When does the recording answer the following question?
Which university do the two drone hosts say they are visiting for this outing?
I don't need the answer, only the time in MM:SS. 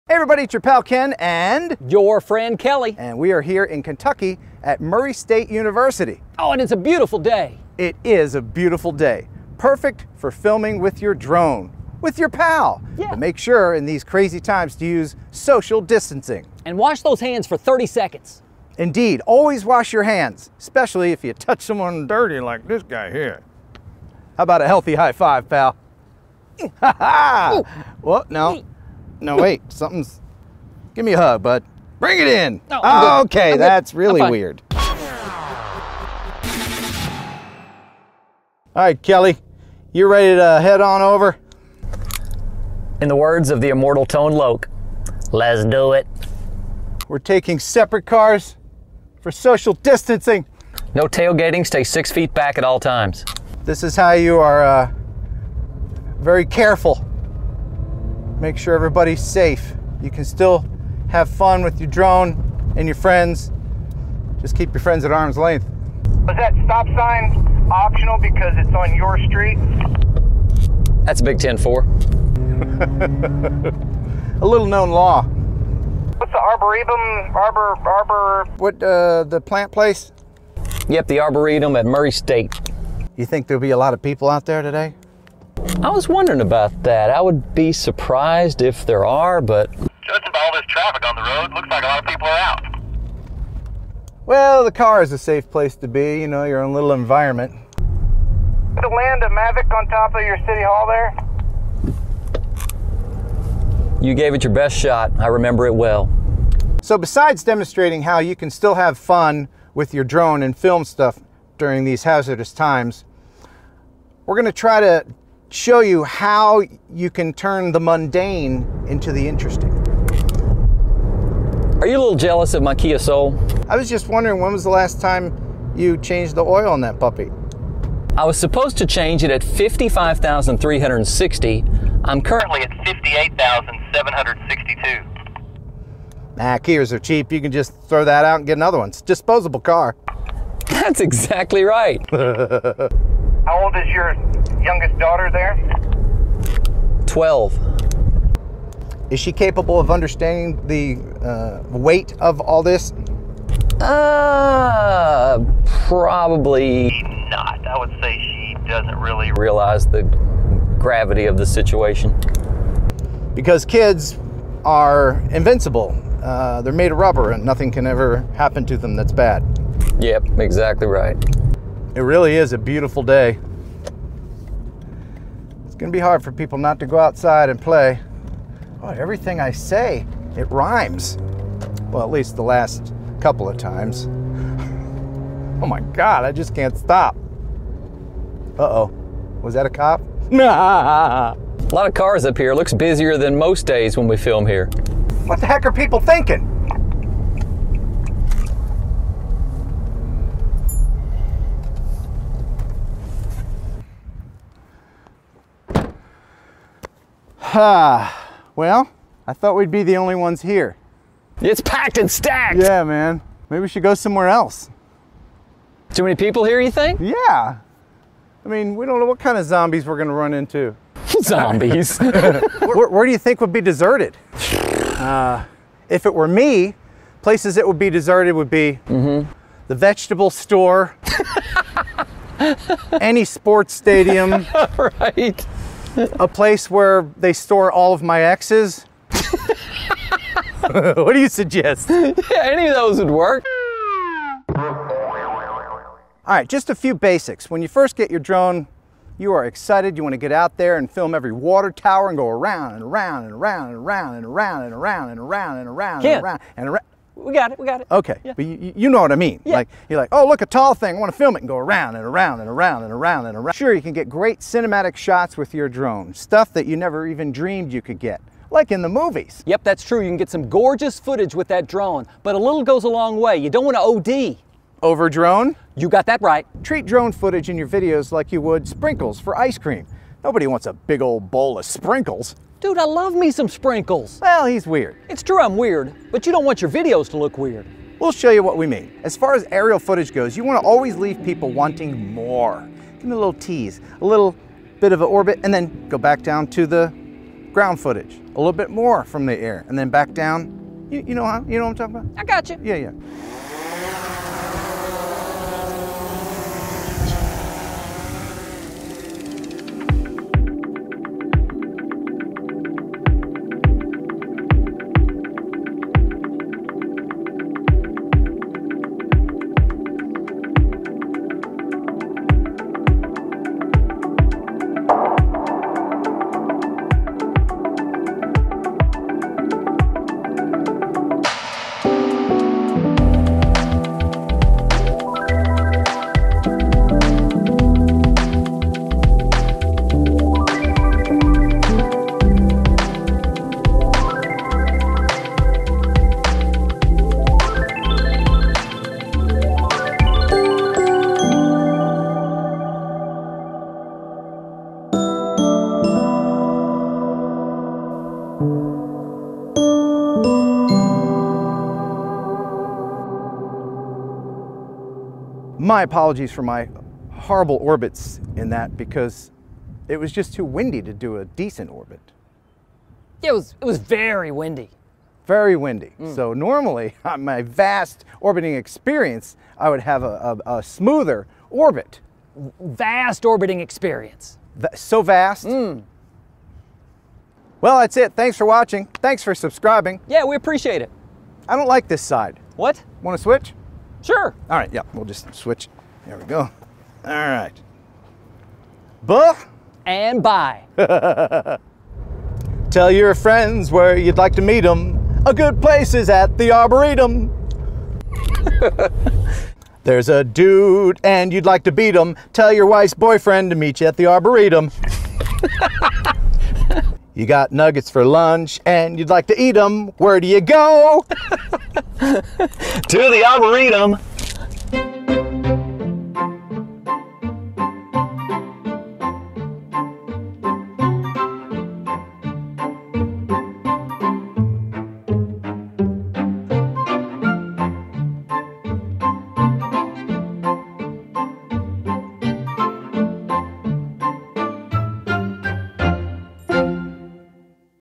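00:04.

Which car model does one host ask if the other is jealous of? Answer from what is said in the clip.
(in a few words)
Kia Soul.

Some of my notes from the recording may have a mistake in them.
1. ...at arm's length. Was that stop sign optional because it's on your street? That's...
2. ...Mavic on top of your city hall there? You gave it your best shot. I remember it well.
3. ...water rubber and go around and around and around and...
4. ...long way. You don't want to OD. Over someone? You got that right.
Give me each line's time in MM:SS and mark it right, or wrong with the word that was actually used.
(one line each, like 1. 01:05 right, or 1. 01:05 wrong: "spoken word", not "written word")
1. 01:05 right
2. 01:39 right
3. 04:11 wrong: "tower", not "rubber"
4. 04:32 wrong: "drone", not "someone".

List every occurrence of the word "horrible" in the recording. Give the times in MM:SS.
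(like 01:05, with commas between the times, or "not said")
06:07.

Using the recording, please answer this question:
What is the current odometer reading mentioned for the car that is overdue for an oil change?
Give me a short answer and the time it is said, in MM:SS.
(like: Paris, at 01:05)
58,762, at 02:12.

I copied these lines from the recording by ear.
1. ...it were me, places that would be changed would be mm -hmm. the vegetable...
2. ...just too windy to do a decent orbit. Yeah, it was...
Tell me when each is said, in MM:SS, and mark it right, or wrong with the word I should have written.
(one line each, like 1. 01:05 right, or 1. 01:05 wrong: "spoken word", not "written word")
1. 03:46 wrong: "deserted", not "changed"
2. 06:10 right.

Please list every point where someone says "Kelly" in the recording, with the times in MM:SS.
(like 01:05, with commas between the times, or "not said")
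00:02, 00:39.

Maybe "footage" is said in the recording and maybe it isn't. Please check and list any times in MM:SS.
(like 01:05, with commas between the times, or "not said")
04:30, 04:37, 04:49, 04:57.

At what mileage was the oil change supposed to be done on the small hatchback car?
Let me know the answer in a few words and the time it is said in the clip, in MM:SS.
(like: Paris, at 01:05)
55,360, at 02:09.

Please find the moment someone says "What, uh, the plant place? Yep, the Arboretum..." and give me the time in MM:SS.
01:18.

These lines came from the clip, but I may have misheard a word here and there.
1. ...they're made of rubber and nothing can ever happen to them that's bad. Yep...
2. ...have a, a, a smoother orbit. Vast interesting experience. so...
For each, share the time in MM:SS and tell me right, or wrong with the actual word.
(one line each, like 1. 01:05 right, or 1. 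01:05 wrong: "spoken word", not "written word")
1. 02:46 right
2. 06:19 wrong: "orbiting", not "interesting".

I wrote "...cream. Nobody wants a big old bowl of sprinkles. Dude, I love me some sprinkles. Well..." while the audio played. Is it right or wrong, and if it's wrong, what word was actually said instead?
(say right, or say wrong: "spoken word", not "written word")
right.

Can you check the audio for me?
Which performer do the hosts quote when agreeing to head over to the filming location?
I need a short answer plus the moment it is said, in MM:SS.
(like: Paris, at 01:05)
Tone Loc, at 00:44.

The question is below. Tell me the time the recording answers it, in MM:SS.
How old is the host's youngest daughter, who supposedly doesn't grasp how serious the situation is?
02:27.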